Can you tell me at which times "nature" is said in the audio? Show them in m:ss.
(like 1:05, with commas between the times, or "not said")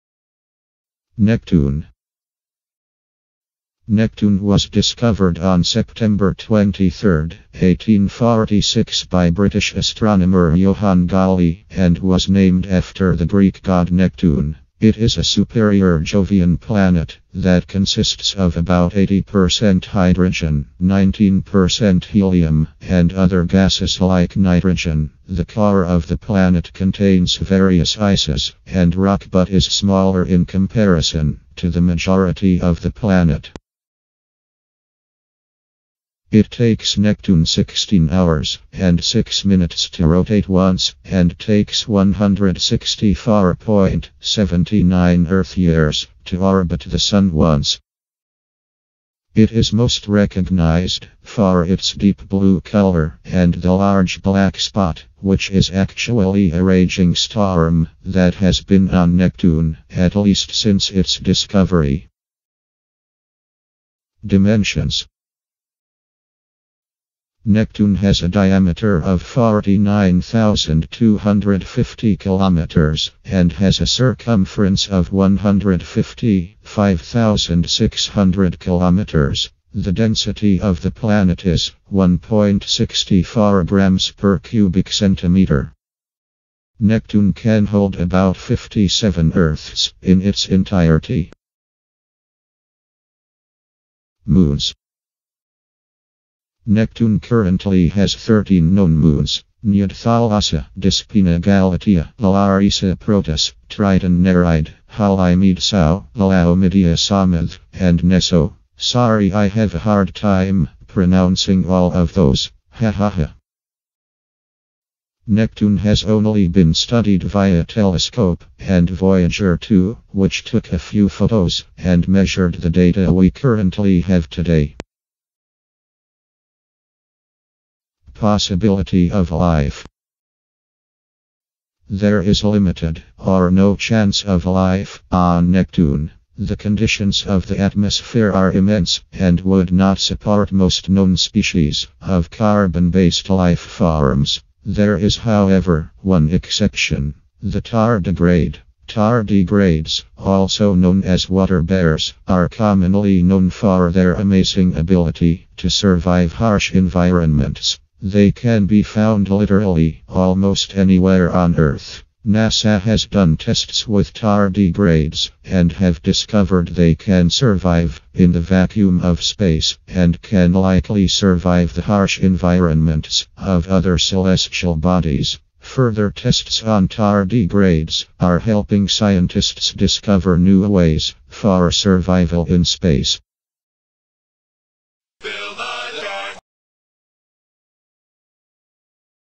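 not said.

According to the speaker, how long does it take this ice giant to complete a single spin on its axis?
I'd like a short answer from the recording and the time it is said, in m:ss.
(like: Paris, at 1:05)
16 hours and 6 minutes, at 0:37.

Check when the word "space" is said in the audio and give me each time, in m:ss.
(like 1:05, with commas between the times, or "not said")
2:49, 3:02.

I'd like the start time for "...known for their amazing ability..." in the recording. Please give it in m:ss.
2:33.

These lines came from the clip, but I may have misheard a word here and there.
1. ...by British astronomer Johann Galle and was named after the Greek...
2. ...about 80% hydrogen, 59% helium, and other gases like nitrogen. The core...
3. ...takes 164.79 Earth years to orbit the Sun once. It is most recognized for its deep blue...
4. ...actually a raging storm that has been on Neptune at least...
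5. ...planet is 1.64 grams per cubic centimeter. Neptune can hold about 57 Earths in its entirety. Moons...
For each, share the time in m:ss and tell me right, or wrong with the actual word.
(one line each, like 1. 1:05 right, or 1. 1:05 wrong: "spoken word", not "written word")
1. 0:09 right
2. 0:18 wrong: "19", not "59"
3. 0:41 right
4. 0:55 right
5. 1:20 right.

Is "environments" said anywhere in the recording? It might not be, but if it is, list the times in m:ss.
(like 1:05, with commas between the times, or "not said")
2:36, 2:52.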